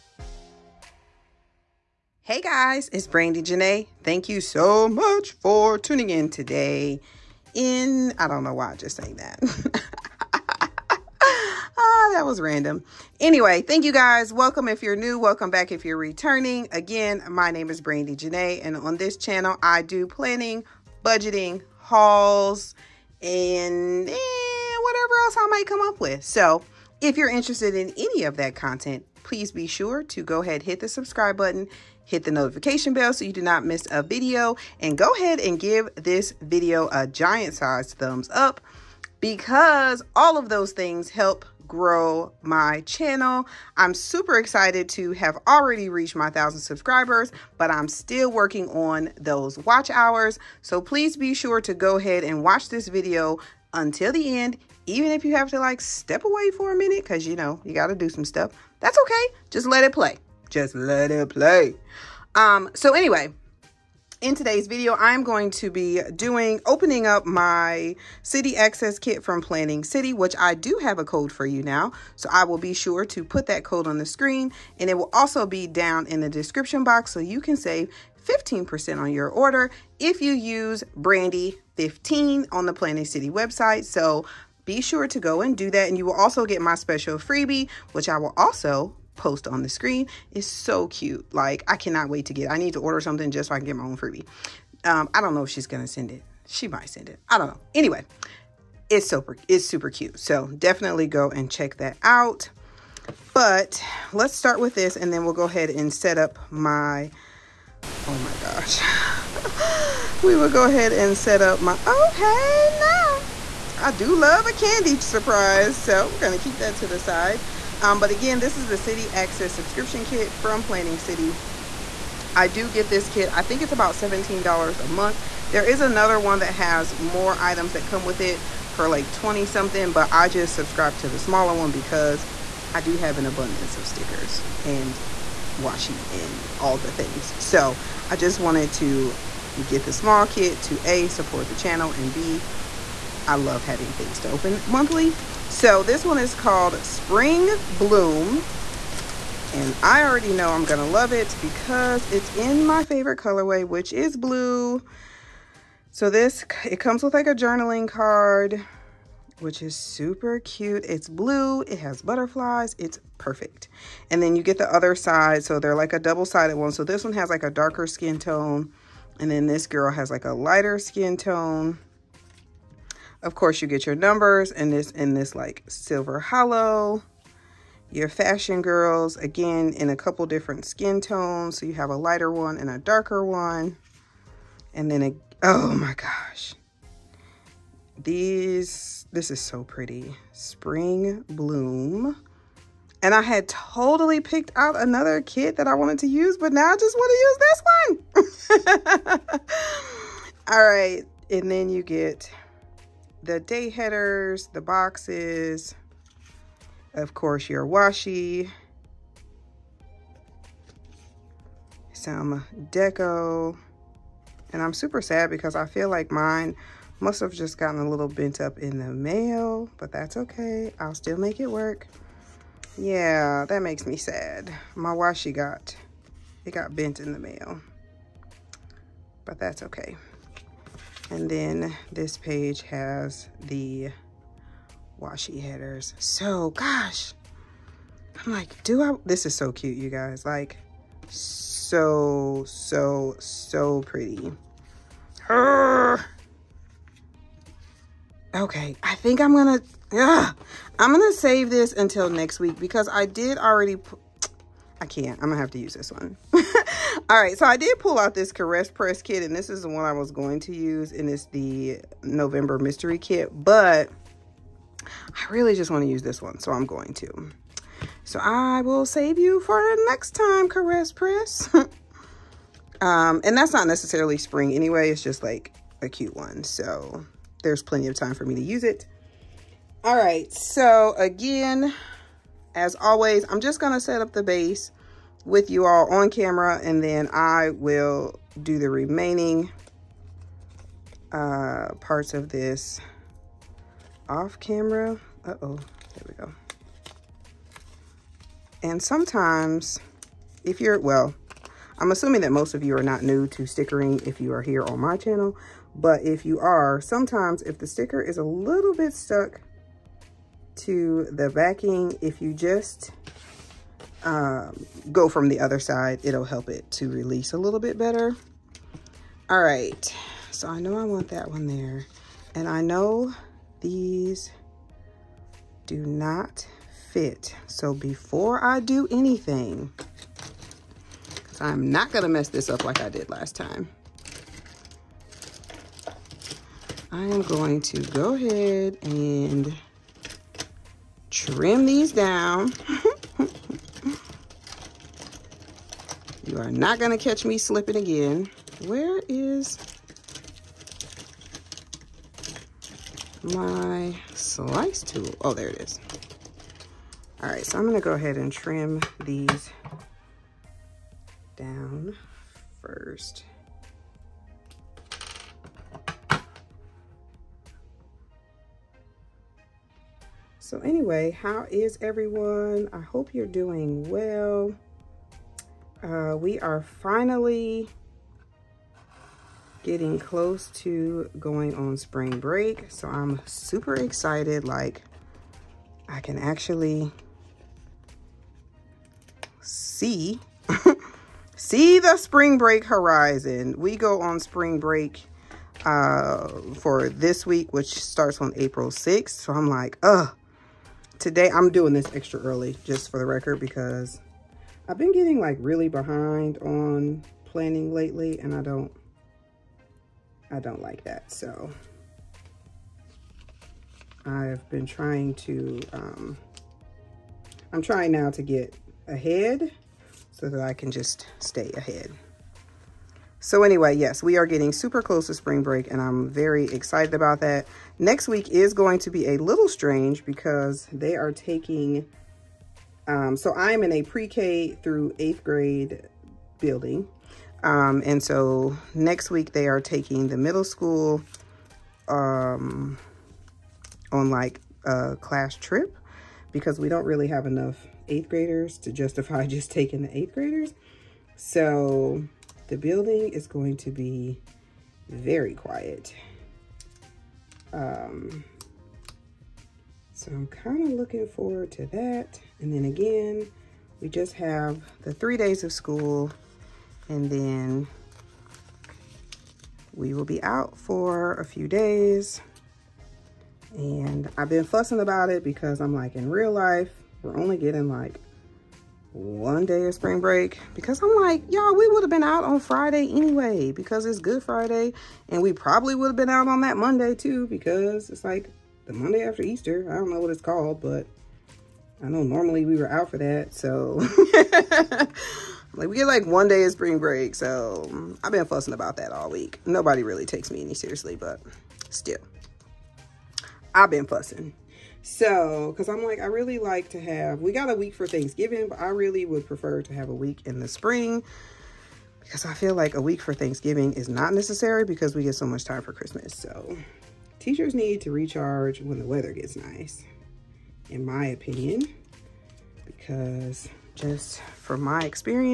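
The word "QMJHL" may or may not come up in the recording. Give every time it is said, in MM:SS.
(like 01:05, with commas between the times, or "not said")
not said.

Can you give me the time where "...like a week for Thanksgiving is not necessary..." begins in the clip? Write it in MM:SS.
08:32.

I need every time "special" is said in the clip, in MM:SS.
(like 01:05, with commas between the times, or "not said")
01:26.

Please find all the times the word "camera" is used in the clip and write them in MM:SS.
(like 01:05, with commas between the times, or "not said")
04:46, 04:54.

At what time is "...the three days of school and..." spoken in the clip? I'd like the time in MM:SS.
07:44.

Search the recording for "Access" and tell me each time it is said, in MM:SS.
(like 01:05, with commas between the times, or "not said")
01:08, 01:59.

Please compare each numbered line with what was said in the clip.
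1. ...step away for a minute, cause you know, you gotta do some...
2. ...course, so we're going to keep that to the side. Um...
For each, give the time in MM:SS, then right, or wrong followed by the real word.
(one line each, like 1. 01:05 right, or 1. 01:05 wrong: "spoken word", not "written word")
1. 00:55 right
2. 01:55 wrong: "surprise", not "course".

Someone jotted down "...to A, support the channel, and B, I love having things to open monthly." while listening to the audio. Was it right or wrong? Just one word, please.
right.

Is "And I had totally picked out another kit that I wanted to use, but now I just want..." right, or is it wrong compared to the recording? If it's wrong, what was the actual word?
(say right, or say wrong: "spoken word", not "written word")
right.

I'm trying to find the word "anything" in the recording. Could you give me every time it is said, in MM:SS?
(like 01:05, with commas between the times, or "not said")
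05:28.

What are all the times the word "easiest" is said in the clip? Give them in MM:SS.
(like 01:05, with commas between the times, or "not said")
not said.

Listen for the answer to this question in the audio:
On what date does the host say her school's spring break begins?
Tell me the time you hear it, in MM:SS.
06:38.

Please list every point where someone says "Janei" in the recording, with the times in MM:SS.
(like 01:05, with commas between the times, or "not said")
00:03, 00:18.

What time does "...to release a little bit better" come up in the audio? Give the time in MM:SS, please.
05:16.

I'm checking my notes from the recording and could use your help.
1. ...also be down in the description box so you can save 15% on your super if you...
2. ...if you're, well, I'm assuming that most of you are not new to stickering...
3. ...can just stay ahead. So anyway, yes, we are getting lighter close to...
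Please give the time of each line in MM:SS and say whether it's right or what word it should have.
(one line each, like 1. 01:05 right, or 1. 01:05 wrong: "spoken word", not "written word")
1. 01:15 wrong: "order", not "super"
2. 05:00 right
3. 07:00 wrong: "super", not "lighter".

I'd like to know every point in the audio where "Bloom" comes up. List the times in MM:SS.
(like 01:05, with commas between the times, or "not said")
02:27, 03:11.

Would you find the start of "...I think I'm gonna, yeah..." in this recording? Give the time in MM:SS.
04:08.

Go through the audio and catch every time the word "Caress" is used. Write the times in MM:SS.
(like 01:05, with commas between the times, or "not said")
04:18, 04:30.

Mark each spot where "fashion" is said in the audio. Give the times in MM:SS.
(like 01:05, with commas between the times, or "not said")
02:58.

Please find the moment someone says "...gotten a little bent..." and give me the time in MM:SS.
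03:37.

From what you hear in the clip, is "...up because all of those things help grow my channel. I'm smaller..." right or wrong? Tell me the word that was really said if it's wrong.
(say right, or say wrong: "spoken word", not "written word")
wrong: "super", not "smaller".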